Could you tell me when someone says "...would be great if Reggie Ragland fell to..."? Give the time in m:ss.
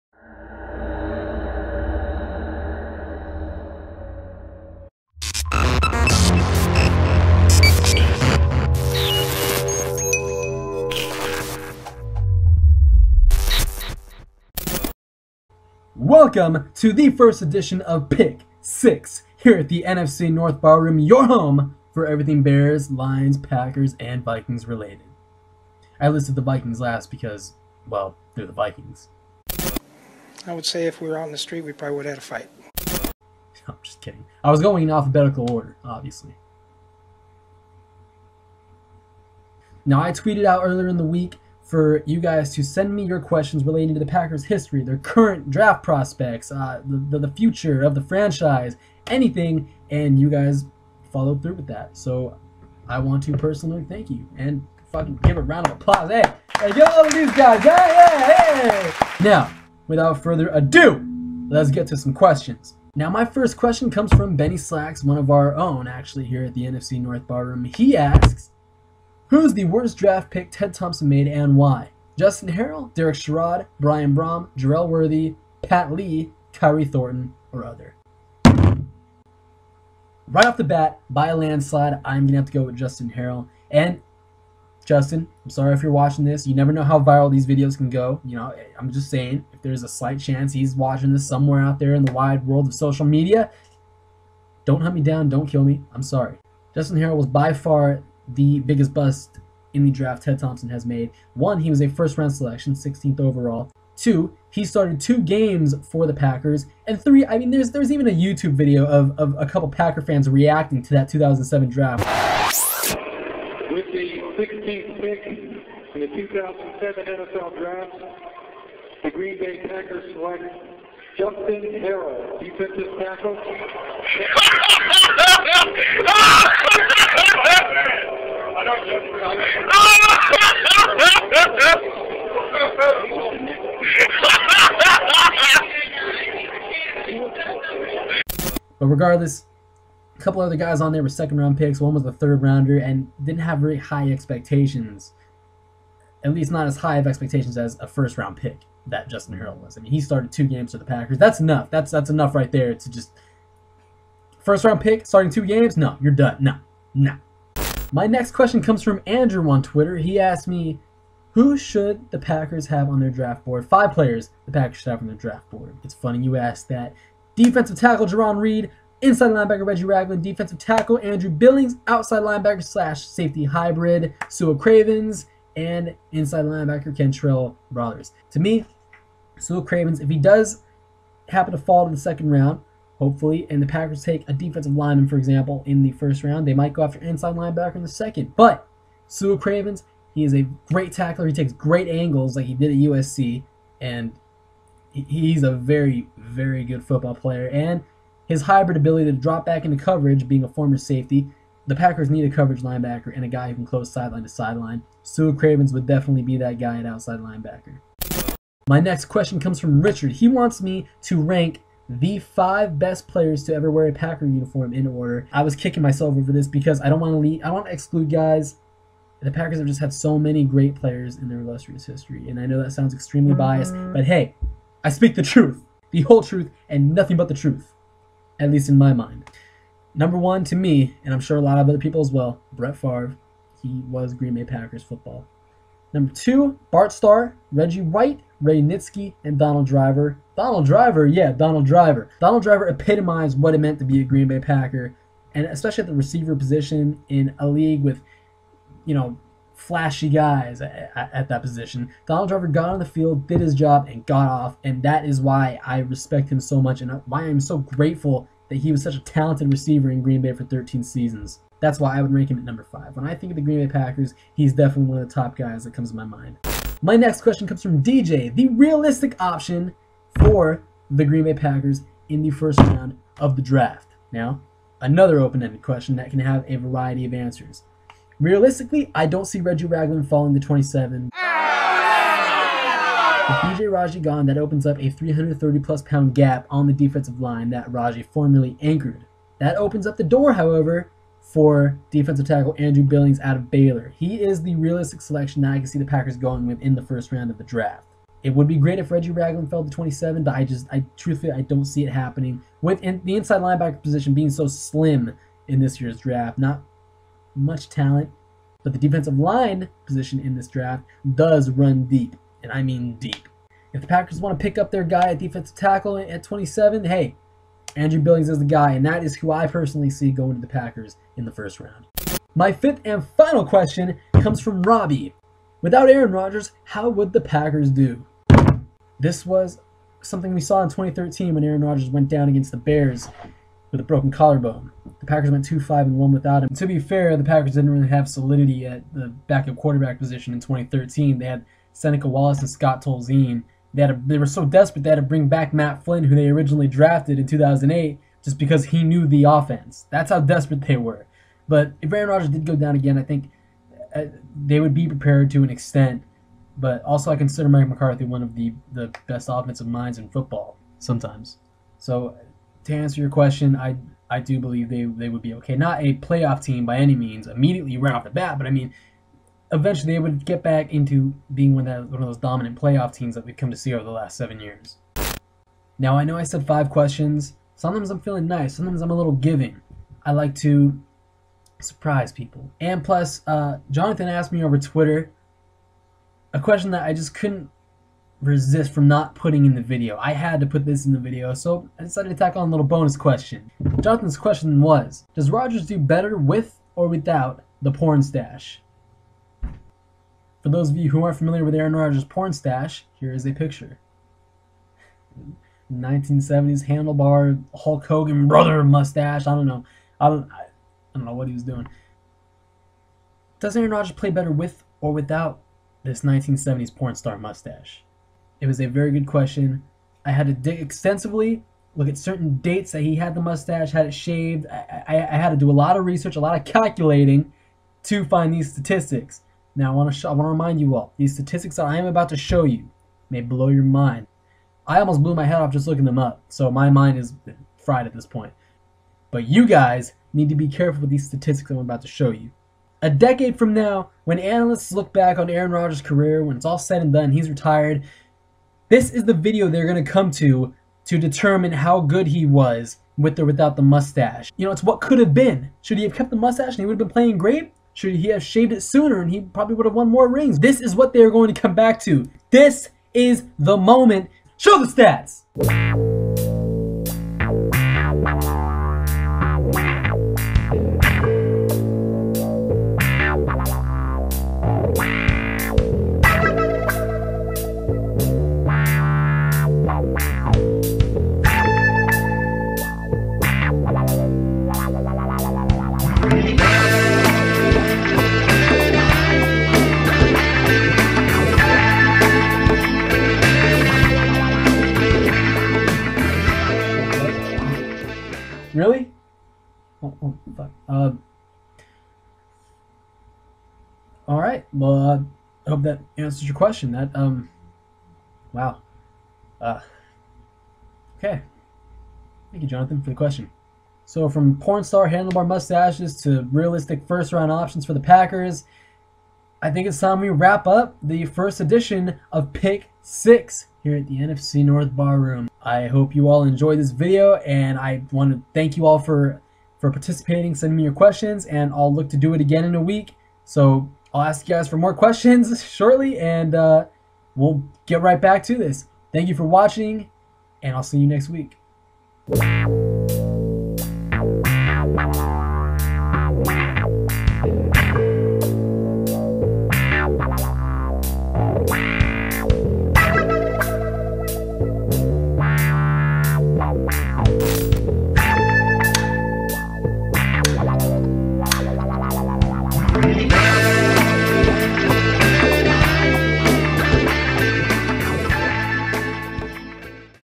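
4:58.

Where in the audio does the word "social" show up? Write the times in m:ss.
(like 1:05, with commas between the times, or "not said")
1:32.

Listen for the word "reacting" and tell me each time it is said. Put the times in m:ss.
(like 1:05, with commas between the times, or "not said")
1:50.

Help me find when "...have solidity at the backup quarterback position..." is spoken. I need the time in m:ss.
5:37.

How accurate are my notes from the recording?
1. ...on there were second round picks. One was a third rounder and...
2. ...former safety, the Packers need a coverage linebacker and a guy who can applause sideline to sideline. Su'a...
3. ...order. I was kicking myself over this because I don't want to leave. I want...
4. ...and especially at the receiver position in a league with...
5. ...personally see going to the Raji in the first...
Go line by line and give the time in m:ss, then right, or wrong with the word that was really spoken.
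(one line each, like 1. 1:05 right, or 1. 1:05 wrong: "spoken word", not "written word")
1. 2:20 right
2. 3:20 wrong: "close", not "applause"
3. 3:34 right
4. 4:05 right
5. 5:19 wrong: "Packers", not "Raji".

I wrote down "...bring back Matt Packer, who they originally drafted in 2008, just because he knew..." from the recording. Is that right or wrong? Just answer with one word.
wrong.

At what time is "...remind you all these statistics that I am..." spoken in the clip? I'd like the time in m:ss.
7:10.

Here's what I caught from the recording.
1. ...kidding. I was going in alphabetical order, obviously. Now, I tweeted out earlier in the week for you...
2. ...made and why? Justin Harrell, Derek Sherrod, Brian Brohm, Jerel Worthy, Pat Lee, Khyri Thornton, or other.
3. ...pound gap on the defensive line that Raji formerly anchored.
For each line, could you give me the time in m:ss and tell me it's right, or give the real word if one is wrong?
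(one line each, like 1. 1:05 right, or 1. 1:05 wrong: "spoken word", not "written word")
1. 0:34 right
2. 1:11 right
3. 4:45 right.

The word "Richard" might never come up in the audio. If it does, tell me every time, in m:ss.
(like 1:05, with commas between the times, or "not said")
3:29.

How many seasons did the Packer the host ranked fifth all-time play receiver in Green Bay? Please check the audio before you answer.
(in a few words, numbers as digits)
13.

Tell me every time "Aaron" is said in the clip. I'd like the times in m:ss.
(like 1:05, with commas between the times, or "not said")
5:25, 5:31, 5:51, 6:41, 6:53, 7:25.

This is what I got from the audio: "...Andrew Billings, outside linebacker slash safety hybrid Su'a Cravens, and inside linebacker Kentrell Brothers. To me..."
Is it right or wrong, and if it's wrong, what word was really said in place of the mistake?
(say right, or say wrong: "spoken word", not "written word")
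right.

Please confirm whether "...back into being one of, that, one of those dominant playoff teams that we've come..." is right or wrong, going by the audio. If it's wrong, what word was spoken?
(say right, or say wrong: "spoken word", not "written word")
right.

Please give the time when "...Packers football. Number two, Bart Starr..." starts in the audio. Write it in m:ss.
3:54.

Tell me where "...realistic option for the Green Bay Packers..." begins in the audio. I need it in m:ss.
4:28.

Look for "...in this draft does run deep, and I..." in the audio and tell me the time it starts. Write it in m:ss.
5:10.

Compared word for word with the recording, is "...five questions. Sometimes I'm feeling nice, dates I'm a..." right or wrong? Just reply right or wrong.
wrong.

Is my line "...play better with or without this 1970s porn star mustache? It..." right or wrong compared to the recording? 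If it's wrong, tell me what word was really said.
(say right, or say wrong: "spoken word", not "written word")
right.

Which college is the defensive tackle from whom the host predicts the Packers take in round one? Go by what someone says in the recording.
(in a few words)
Baylor.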